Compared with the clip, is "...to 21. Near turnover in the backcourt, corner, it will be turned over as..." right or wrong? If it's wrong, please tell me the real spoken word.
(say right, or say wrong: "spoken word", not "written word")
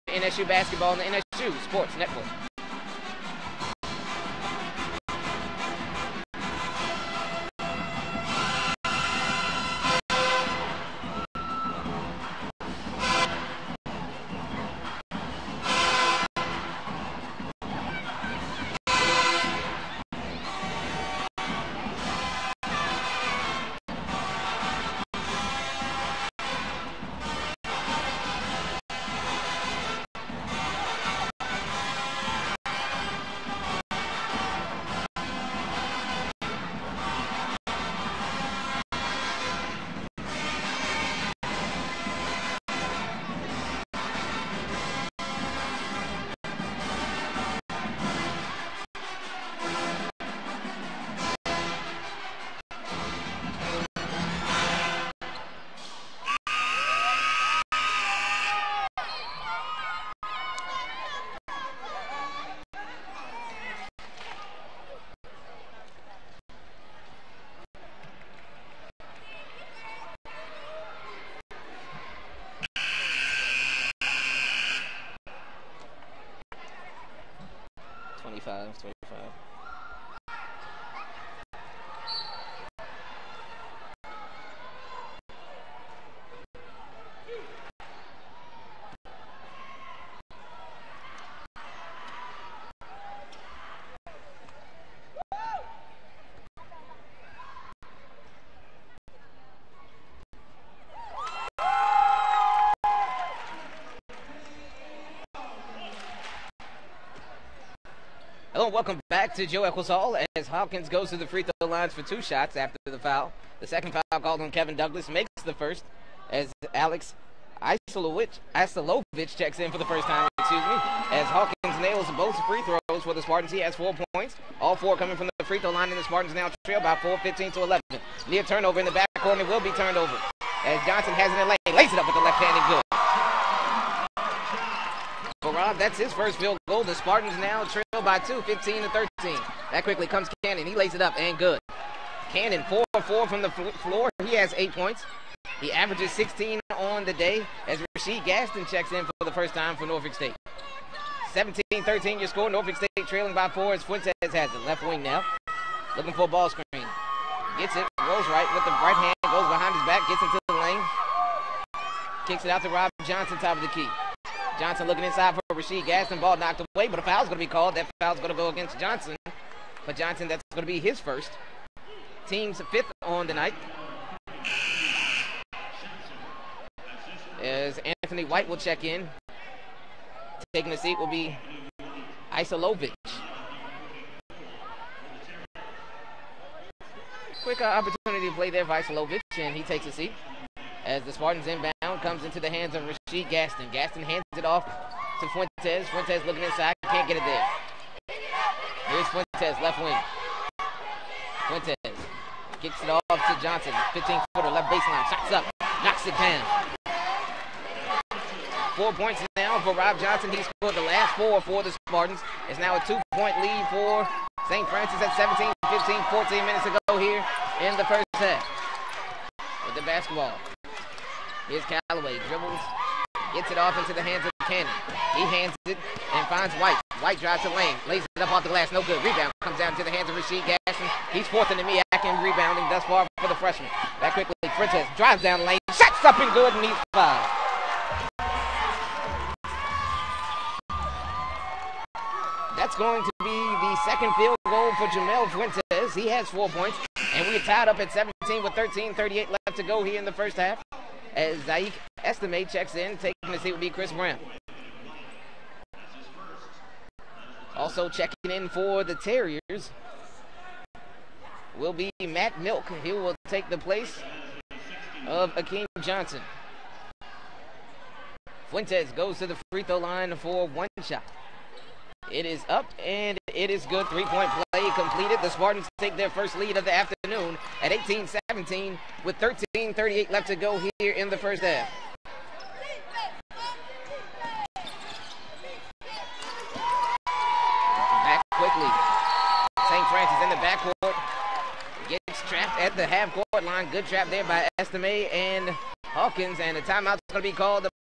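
wrong: "11", not "21".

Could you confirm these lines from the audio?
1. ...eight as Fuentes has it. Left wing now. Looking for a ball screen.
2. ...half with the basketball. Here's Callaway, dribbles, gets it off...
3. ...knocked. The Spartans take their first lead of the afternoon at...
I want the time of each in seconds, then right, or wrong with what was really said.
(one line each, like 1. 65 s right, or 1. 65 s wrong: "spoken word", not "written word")
1. 153 s wrong: "four", not "eight"
2. 218 s right
3. 274 s wrong: "completed", not "knocked".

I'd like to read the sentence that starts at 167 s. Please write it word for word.
That foul's going to go against Johnson.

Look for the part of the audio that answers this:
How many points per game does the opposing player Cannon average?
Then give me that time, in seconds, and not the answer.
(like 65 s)
146 s.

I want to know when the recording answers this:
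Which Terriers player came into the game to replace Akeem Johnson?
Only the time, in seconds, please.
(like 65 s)
262 s.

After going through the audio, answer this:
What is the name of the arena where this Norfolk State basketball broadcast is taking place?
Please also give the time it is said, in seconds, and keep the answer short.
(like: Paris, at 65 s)
Joe Echols Hall, at 109 s.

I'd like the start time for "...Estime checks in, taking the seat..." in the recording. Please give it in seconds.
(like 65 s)
252 s.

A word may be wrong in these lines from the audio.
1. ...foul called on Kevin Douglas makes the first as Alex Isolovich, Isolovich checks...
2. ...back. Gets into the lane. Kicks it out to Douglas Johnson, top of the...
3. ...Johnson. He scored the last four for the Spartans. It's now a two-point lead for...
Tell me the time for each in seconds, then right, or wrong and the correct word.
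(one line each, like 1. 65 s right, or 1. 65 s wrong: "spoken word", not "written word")
1. 113 s right
2. 159 s wrong: "Rob", not "Douglas"
3. 209 s right.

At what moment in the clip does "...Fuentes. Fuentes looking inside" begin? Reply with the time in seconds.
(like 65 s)
195 s.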